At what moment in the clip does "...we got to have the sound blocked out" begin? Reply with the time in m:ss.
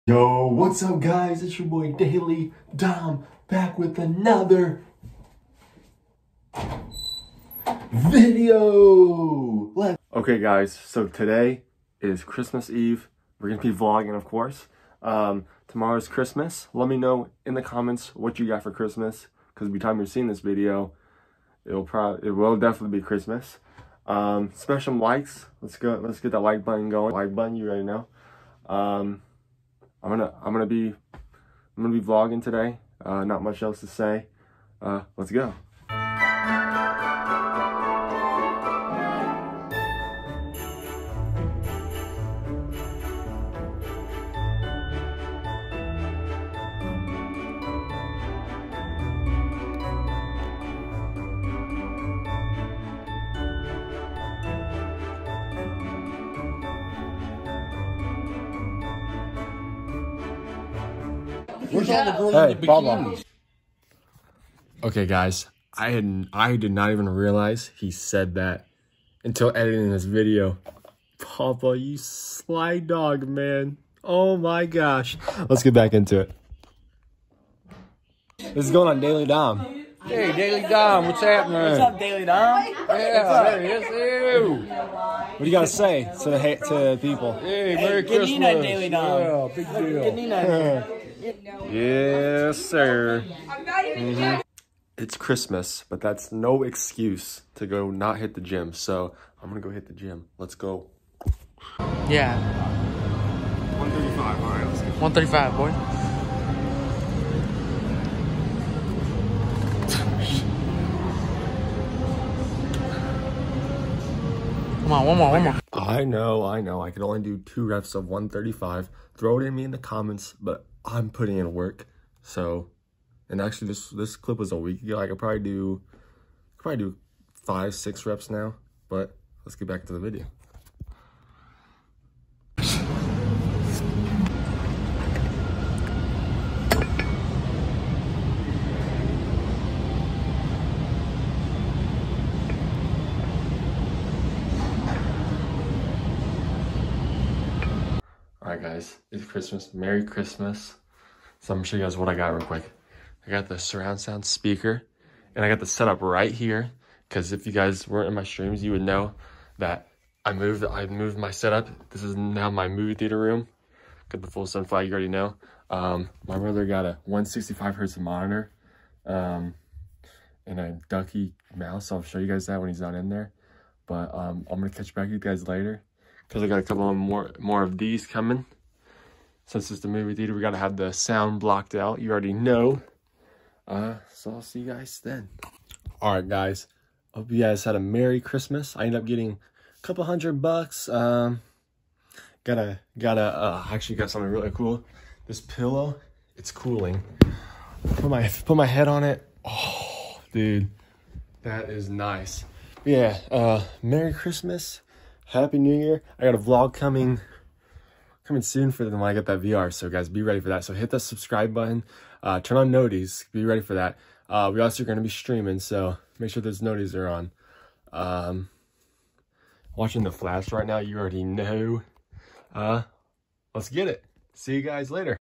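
3:00.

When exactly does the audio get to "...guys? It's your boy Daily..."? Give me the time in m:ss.
0:00.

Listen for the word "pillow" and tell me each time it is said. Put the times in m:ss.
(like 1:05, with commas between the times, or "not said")
3:15.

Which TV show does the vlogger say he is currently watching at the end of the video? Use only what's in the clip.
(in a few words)
The Flash.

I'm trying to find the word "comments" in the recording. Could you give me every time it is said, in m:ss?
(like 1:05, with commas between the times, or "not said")
0:17, 1:59.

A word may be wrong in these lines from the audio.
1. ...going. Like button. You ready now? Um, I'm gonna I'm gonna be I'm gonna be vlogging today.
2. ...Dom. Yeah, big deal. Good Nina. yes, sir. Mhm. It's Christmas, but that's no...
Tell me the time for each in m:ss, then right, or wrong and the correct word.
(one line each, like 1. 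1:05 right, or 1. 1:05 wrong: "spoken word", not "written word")
1. 0:26 right
2. 1:28 right.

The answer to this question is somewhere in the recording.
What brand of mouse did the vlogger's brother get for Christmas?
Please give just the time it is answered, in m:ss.
2:50.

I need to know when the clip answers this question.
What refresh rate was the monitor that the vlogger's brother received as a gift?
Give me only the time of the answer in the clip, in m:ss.
2:47.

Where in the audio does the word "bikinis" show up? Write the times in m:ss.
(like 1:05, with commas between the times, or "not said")
1:02.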